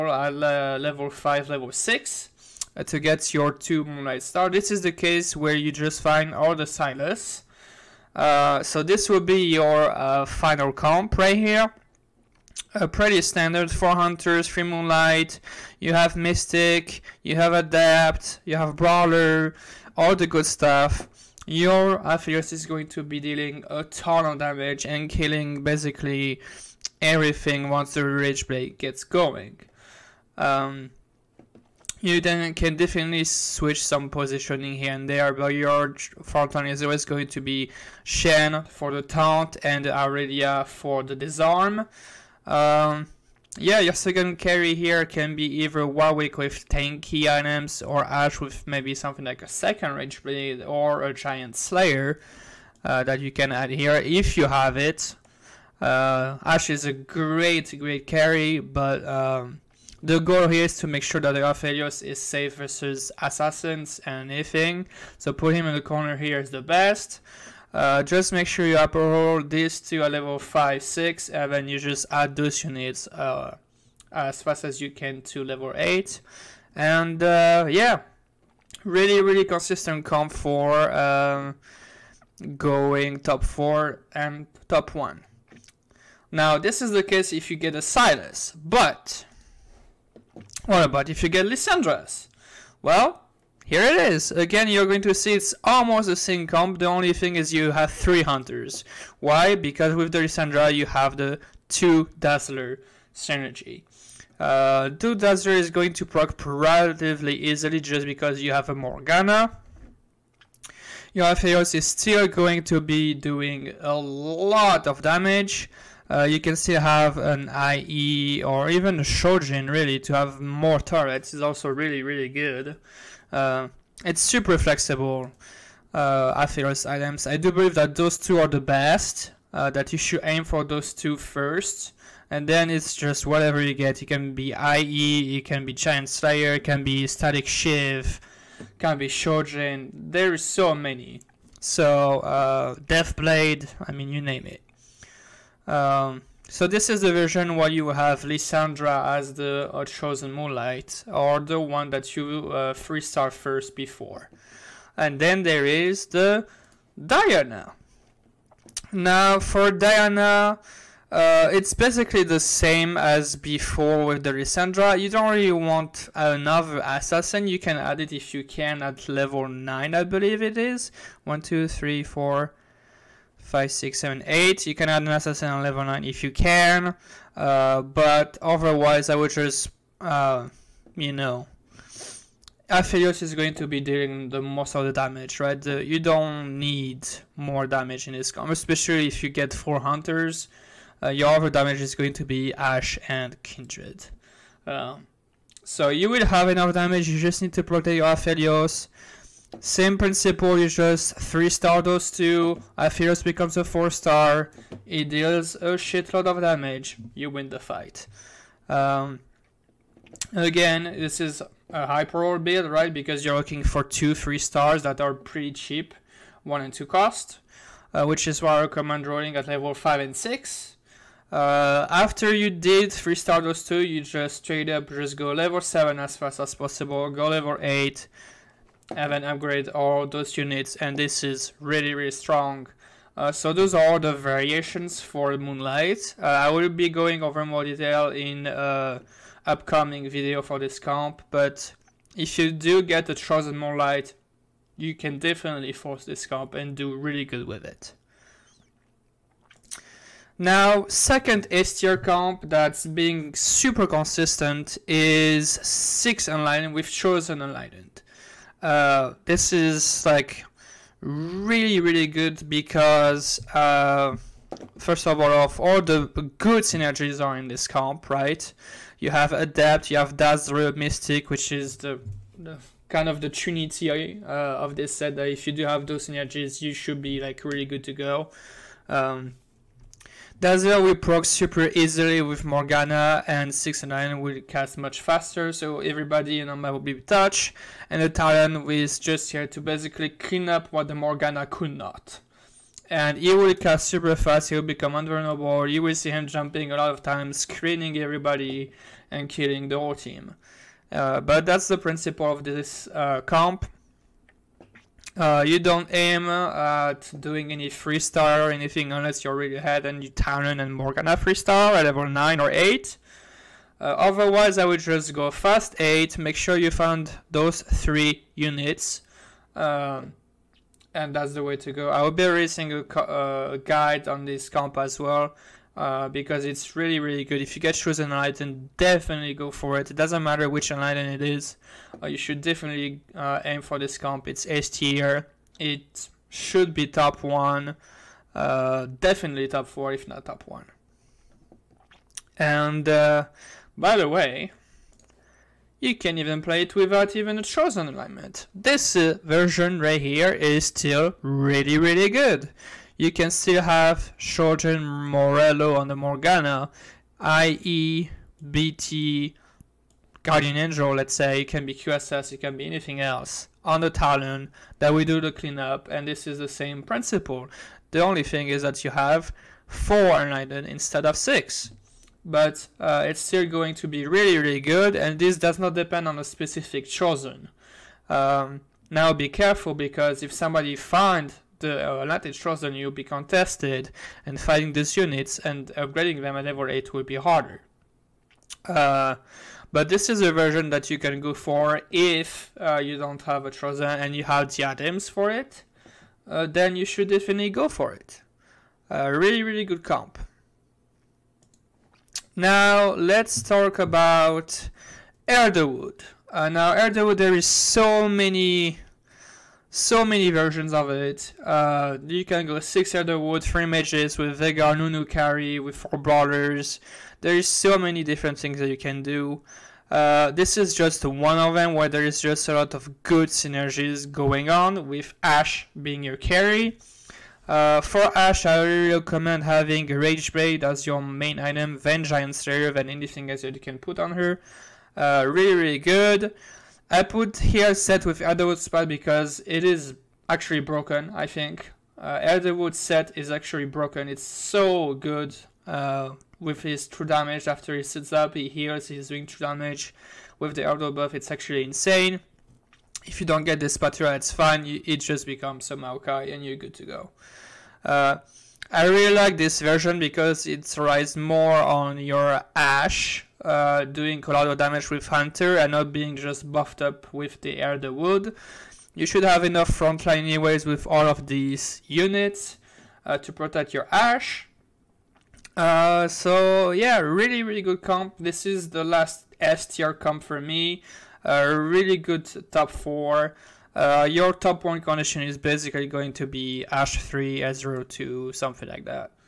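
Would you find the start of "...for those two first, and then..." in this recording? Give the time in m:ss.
2:10.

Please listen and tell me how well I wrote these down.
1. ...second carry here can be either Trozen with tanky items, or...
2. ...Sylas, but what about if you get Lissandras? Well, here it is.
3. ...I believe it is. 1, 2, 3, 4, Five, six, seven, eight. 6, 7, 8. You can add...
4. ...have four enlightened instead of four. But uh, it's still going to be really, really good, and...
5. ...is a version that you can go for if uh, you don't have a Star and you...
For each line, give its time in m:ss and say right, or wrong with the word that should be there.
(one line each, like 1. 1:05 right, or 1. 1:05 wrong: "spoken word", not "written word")
1. 0:43 wrong: "Warwick", not "Trozen"
2. 1:27 right
3. 2:49 right
4. 6:08 wrong: "six", not "four"
5. 6:30 wrong: "Trozen", not "Star".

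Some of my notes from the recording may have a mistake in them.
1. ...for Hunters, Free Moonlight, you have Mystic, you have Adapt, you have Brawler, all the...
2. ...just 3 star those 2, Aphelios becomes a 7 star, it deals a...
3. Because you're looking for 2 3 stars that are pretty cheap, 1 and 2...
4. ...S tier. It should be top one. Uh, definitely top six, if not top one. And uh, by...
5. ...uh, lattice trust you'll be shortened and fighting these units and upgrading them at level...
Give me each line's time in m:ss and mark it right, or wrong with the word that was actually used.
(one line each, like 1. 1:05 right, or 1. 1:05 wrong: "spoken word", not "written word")
1. 0:13 right
2. 3:20 wrong: "4", not "7"
3. 3:32 right
4. 5:34 wrong: "four", not "six"
5. 6:22 wrong: "contested", not "shortened".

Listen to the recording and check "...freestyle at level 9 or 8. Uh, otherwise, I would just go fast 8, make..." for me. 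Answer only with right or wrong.
right.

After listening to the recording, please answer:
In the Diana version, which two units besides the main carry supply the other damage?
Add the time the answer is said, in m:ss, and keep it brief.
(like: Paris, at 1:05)
Ash and Kindred, at 3:12.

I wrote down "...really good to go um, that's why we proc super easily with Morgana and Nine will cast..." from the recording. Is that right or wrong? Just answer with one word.
right.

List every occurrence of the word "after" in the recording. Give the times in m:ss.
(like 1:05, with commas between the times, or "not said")
3:41, 7:27.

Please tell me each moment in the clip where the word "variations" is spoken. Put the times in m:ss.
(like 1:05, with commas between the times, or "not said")
3:54.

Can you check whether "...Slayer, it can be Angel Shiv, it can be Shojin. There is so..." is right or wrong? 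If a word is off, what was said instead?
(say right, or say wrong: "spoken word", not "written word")
wrong: "Static", not "Angel".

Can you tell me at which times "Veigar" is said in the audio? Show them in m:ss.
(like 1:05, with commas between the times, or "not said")
6:54.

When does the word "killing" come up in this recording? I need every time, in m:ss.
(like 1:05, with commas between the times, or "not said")
0:25, 4:59.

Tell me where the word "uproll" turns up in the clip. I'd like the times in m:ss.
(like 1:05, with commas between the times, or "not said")
1:08.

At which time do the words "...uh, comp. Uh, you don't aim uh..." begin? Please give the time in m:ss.
5:02.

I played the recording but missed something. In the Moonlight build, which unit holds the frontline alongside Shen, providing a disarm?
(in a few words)
Aurelia.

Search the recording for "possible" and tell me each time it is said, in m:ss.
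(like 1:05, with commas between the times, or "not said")
3:46.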